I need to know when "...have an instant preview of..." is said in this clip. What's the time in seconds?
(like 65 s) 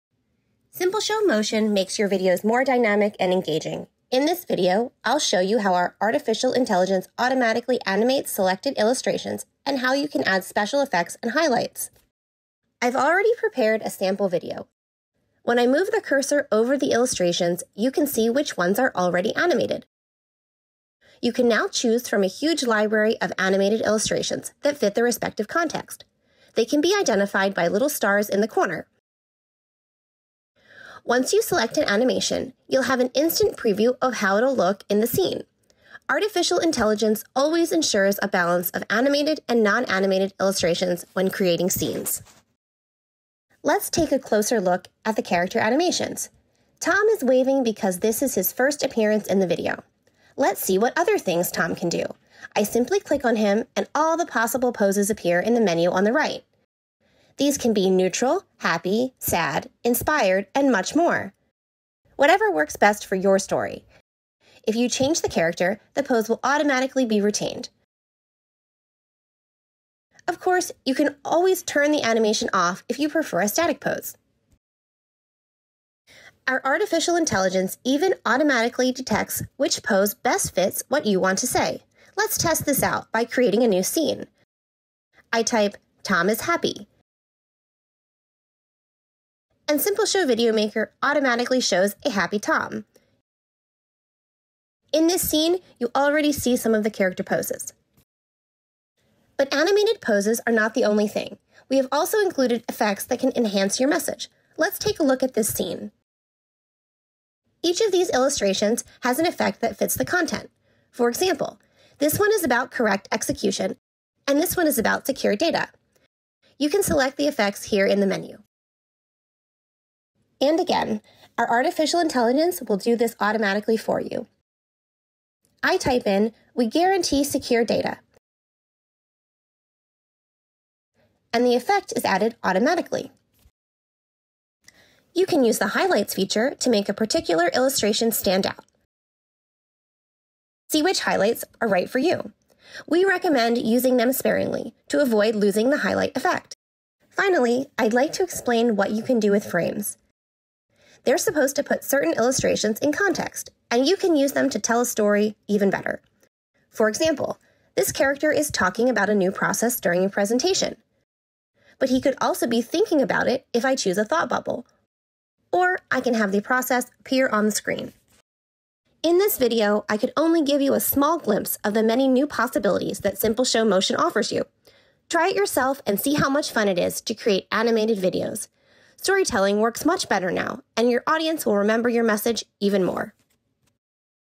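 32 s.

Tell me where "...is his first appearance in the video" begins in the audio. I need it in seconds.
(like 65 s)
48 s.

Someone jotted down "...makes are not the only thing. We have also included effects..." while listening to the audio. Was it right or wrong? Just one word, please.
wrong.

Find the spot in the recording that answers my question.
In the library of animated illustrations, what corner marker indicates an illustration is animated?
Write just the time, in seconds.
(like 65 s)
27 s.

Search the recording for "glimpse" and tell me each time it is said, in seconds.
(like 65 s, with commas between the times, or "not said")
171 s.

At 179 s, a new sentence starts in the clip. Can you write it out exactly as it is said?
Storytelling works much better now, and your audience will remember your message even more.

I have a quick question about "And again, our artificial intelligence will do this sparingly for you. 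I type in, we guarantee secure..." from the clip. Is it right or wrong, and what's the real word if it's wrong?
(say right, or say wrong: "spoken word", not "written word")
wrong: "automatically", not "sparingly".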